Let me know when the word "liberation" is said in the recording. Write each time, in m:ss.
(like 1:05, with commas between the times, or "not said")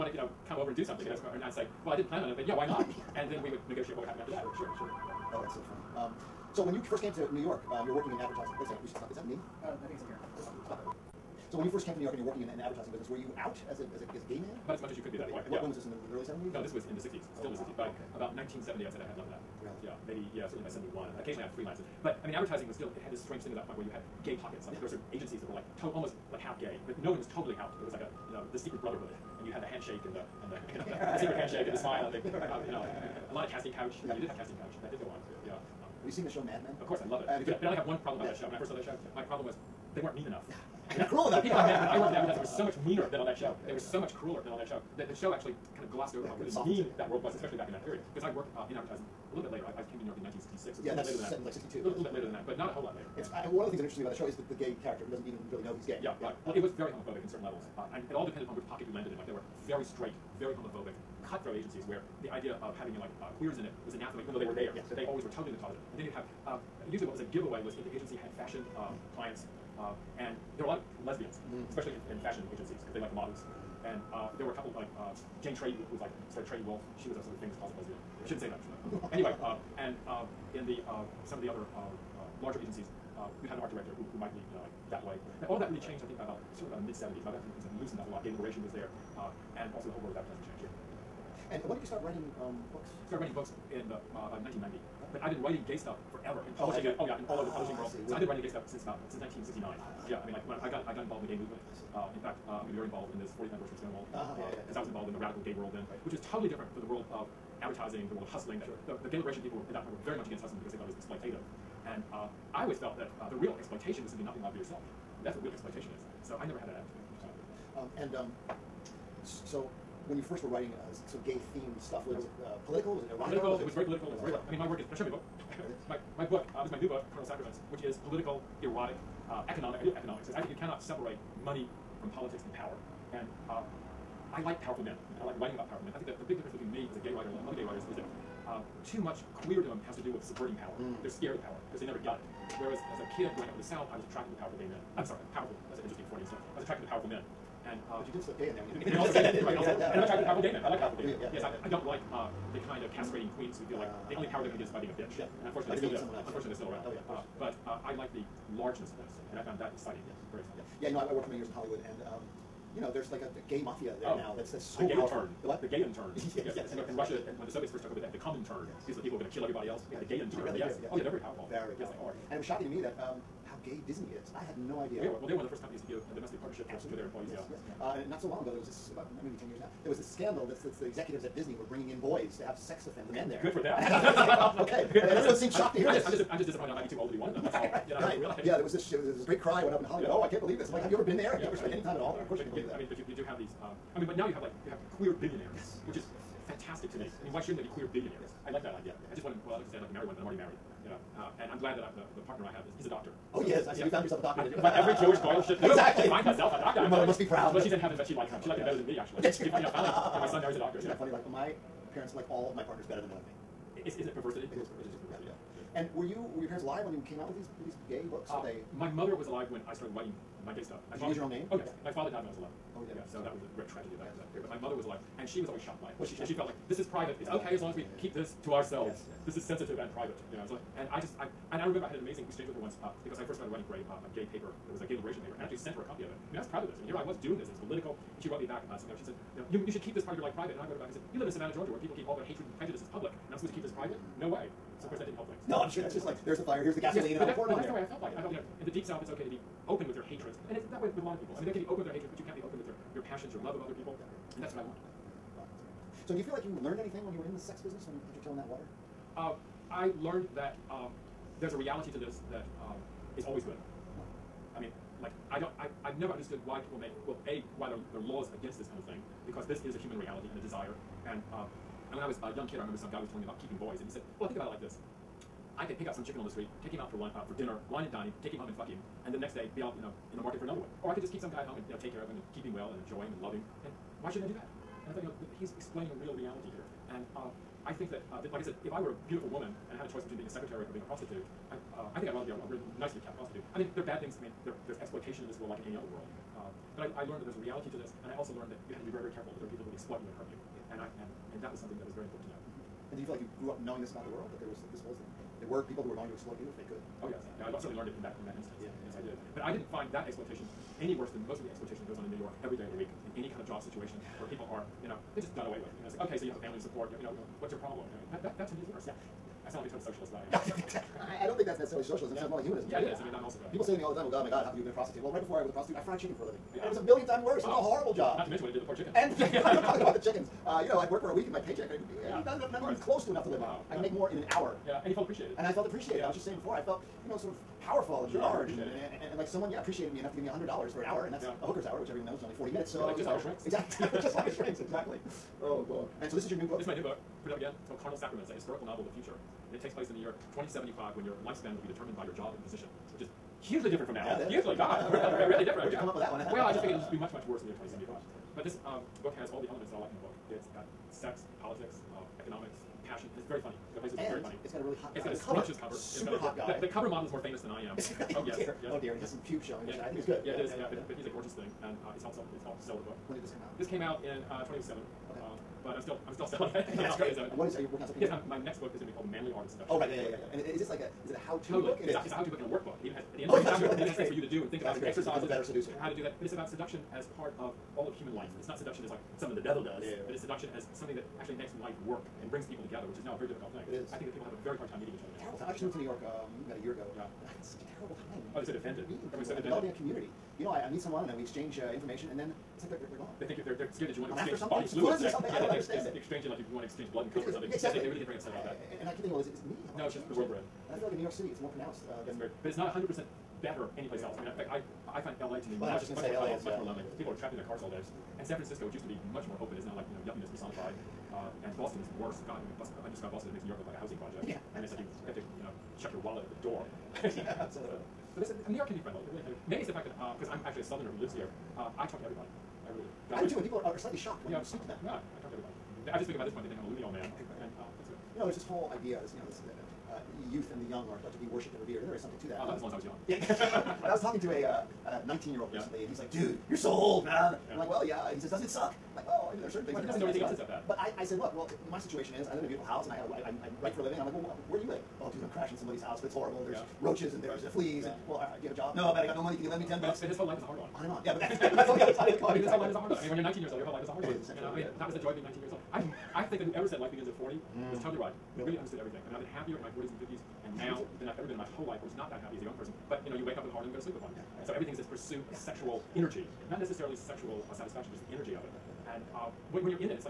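1:28, 1:49, 3:54.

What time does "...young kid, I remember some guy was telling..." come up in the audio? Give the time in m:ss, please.
4:32.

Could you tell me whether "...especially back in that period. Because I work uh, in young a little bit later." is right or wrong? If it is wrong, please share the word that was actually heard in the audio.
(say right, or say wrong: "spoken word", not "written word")
wrong: "advertising", not "young".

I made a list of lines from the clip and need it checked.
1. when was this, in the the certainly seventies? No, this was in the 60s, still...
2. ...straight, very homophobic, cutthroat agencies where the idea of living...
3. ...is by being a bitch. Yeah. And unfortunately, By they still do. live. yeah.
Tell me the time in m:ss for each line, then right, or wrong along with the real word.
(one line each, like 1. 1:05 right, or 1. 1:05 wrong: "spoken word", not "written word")
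1. 0:15 wrong: "early", not "certainly"
2. 0:59 wrong: "having", not "living"
3. 2:34 right.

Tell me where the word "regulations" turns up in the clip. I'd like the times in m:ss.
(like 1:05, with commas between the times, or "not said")
not said.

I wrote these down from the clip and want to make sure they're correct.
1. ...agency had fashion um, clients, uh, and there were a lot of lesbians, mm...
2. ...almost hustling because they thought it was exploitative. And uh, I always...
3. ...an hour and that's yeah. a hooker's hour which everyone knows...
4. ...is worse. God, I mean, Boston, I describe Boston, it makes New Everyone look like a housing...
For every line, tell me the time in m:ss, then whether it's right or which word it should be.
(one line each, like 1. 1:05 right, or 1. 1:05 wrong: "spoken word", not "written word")
1. 1:07 right
2. 1:50 wrong: "against", not "almost"
3. 5:40 right
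4. 7:01 wrong: "York", not "Everyone".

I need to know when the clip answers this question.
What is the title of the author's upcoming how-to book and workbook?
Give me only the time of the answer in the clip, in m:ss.
6:19.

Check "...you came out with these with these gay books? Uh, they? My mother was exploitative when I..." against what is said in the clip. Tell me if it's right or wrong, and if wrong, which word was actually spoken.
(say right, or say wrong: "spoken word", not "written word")
wrong: "alive", not "exploitative".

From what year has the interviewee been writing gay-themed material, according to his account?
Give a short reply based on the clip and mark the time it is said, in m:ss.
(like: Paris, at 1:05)
1969, at 1:39.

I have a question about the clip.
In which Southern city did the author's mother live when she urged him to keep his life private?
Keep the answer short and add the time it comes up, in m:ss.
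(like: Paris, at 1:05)
Savannah, Georgia, at 4:01.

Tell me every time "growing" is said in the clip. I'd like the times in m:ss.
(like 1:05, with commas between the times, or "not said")
2:23.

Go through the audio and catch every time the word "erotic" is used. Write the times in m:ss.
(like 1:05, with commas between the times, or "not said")
2:03, 2:08.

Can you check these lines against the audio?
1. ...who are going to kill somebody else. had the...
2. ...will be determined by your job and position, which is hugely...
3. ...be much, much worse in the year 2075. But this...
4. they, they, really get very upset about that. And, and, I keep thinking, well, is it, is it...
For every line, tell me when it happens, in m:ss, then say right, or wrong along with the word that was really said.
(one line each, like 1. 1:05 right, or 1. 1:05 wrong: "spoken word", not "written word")
1. 2:49 wrong: "everybody", not "somebody"
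2. 5:51 right
3. 5:56 right
4. 6:47 right.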